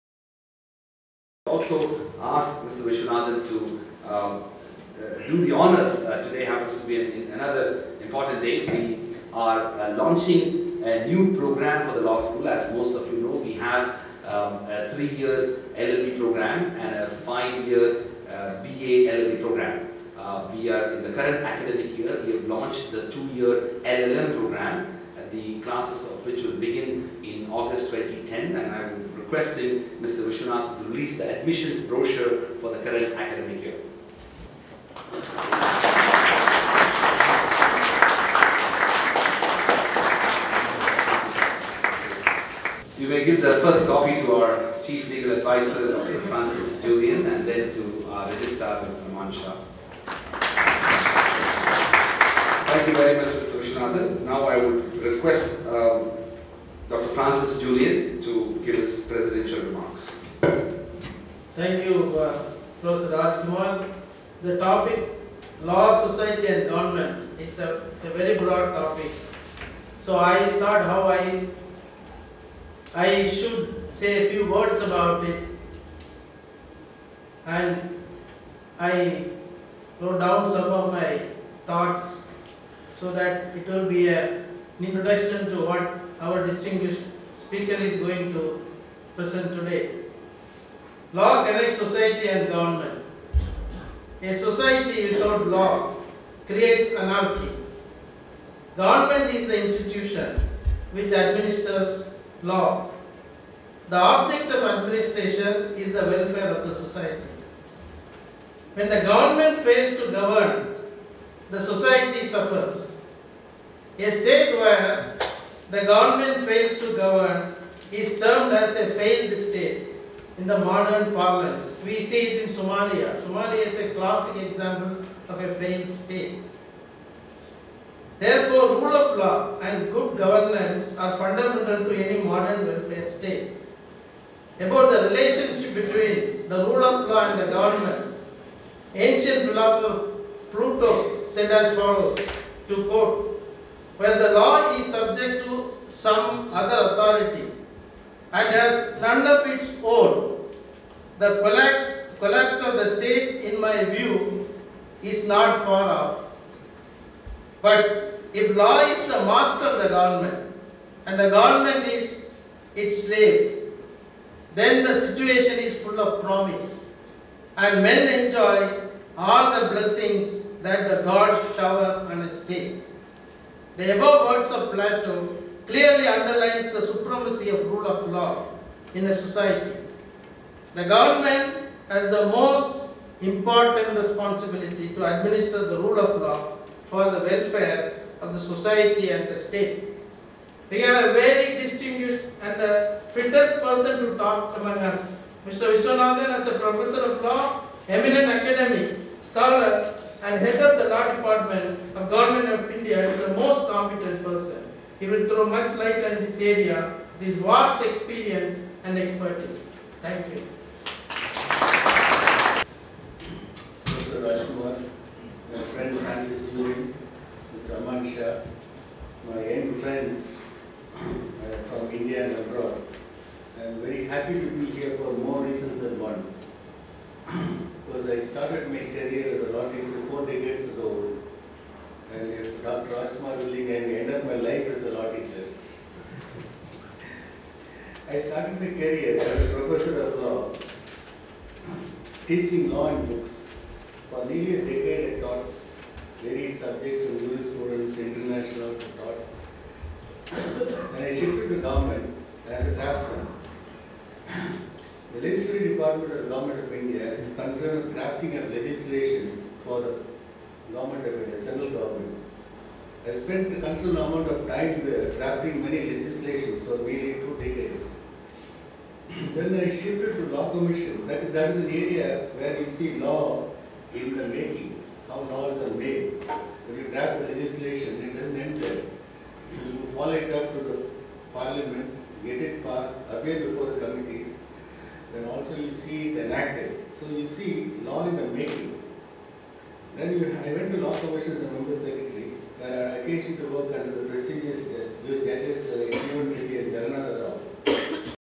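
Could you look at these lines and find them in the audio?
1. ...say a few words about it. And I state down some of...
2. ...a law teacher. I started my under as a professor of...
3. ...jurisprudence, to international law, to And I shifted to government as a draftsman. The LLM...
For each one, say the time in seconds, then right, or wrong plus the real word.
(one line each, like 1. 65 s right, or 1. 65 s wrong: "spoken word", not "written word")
1. 73 s wrong: "wrote", not "state"
2. 234 s wrong: "career", not "under"
3. 247 s wrong: "Legislative", not "LLM".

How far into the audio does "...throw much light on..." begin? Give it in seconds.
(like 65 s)
205 s.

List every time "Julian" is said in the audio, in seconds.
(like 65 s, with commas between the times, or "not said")
46 s, 57 s.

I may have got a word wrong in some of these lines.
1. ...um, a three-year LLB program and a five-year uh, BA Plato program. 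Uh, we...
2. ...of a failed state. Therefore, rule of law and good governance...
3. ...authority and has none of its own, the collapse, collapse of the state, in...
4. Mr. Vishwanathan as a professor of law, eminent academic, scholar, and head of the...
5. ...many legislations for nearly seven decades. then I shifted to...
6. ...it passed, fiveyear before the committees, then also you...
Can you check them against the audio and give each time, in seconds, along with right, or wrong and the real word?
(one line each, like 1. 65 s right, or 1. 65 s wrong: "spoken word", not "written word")
1. 14 s wrong: "LLB", not "Plato"
2. 125 s right
3. 146 s right
4. 195 s right
5. 265 s wrong: "two", not "seven"
6. 282 s wrong: "appear", not "fiveyear".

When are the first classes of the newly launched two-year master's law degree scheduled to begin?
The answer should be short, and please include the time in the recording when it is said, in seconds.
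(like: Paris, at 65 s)
August 2010, at 27 s.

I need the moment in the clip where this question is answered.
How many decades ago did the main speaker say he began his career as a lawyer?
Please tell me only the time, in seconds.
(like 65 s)
230 s.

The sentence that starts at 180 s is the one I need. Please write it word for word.
The government has the most important responsibility to administer the rule of law for the welfare of the society and the state.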